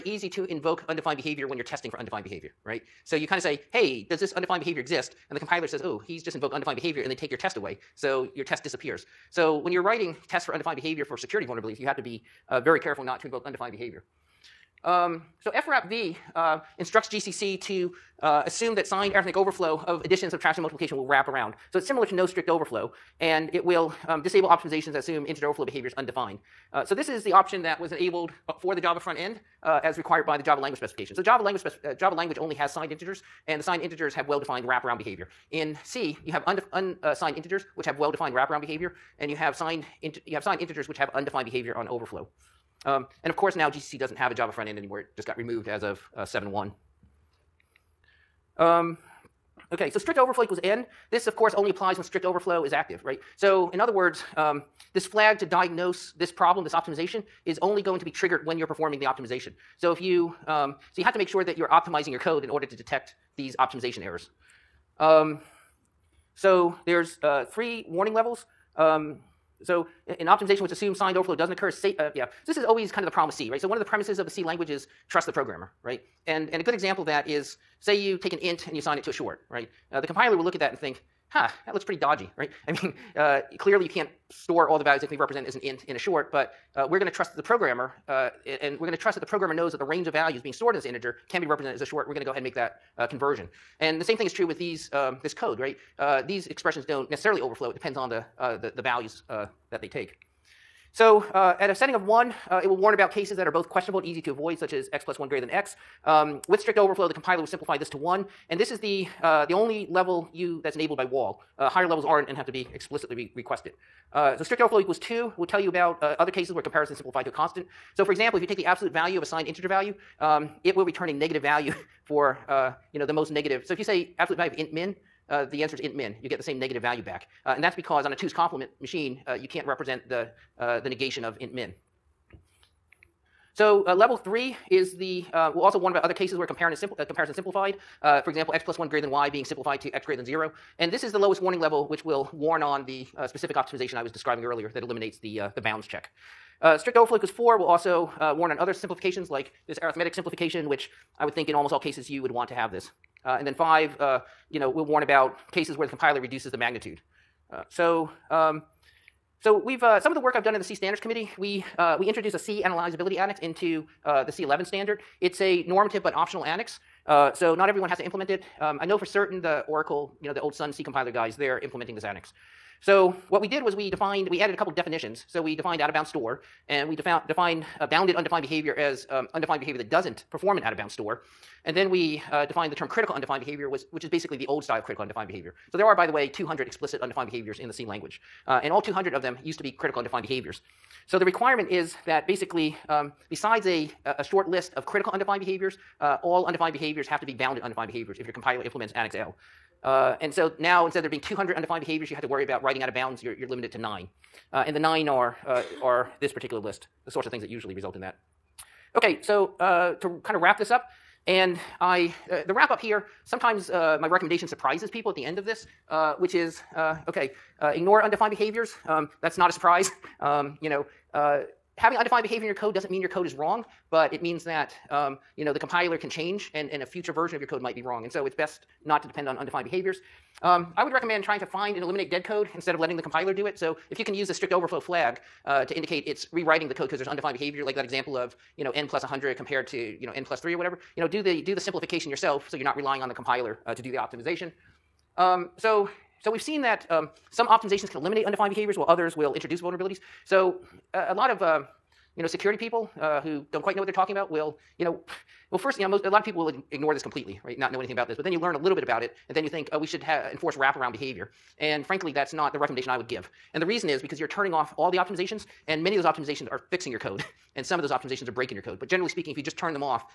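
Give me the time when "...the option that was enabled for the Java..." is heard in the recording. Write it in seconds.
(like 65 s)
27 s.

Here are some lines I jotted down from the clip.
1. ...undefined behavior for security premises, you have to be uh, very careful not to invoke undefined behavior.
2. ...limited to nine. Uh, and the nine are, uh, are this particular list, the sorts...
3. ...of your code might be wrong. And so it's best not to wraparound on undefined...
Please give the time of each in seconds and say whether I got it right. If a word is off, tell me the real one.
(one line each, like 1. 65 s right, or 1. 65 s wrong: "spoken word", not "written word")
1. 10 s wrong: "vulnerabilities", not "premises"
2. 203 s right
3. 227 s wrong: "depend", not "wraparound".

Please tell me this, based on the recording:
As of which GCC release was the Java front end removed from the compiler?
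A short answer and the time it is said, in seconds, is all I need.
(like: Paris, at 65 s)
7.1, at 46 s.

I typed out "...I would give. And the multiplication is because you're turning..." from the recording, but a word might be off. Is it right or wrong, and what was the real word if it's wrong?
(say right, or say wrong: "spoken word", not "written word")
wrong: "reason", not "multiplication".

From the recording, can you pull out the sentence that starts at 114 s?
Uh, so strict overflow equals two will tell you about uh, other cases where comparison simplified to a constant.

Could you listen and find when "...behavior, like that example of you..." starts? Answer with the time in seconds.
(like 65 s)
237 s.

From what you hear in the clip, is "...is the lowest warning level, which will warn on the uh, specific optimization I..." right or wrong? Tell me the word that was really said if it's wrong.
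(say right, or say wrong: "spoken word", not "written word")
right.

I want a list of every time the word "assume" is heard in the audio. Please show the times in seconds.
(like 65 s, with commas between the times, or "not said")
18 s, 24 s, 70 s.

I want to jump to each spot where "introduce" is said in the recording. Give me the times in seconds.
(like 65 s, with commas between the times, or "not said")
162 s, 249 s.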